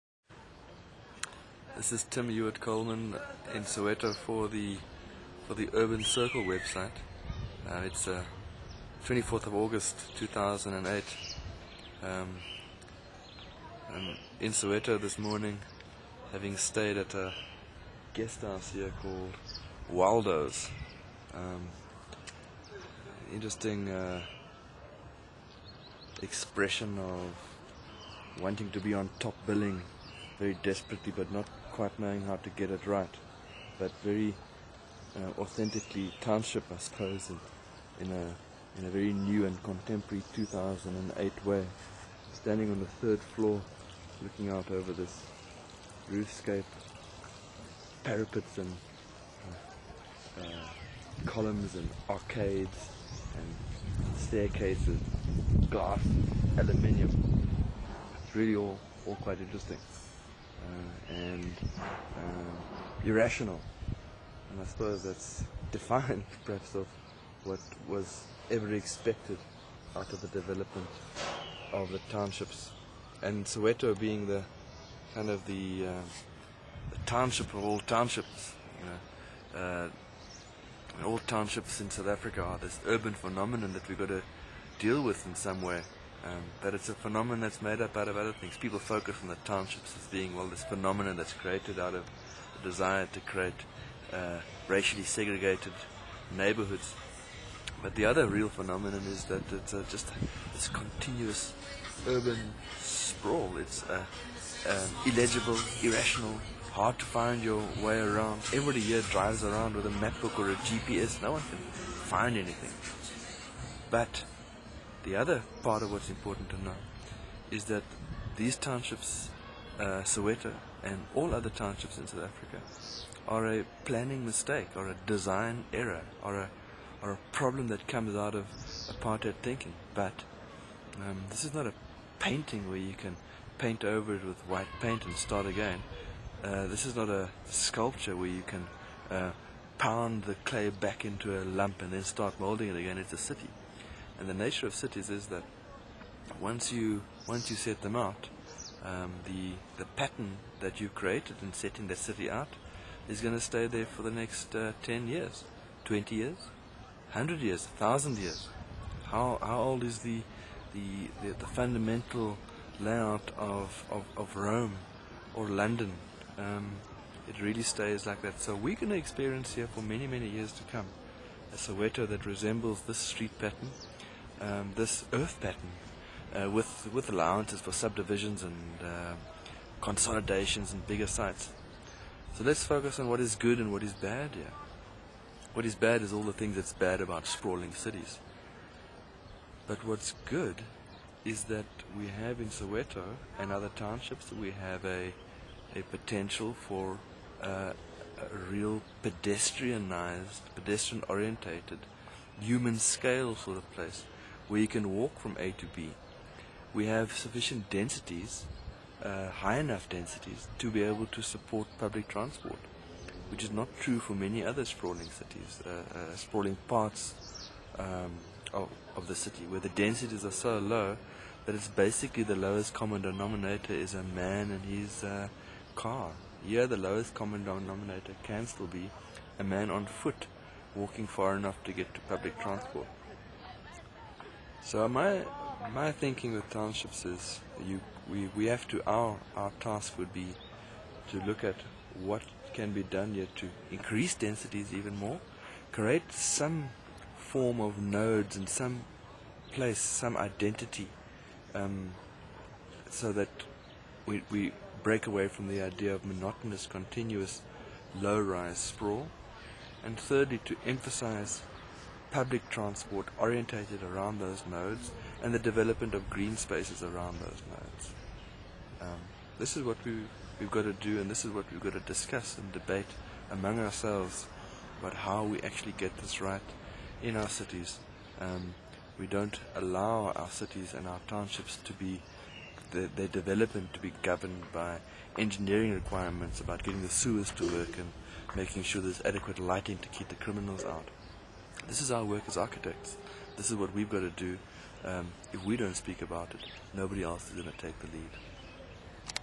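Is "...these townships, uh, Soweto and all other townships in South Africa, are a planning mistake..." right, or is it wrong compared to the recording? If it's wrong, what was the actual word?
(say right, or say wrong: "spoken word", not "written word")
right.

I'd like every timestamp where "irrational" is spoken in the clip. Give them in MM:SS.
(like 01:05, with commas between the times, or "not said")
01:03, 01:45.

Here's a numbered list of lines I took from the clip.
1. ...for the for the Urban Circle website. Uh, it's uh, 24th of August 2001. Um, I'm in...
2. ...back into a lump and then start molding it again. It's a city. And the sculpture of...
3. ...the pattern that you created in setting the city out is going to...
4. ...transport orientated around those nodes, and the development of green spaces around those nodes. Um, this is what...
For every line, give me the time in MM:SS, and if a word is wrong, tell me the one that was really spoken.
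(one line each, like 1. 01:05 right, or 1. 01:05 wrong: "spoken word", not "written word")
1. 00:04 wrong: "2008", not "2001"
2. 02:20 wrong: "nature", not "sculpture"
3. 02:29 right
4. 04:22 right.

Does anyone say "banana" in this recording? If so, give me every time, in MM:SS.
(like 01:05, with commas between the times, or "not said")
not said.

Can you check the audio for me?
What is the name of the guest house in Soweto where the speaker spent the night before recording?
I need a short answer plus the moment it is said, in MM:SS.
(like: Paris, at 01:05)
Waldo's, at 00:19.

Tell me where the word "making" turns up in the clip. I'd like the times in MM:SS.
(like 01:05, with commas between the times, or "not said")
04:48.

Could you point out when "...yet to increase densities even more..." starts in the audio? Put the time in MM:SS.
04:03.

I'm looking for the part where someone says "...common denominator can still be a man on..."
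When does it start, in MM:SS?
03:47.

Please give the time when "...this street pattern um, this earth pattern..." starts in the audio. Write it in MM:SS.
02:52.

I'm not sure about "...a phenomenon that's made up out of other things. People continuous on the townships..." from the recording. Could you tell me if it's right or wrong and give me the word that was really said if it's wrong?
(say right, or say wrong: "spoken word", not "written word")
wrong: "focus", not "continuous".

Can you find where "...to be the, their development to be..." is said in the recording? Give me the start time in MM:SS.
04:41.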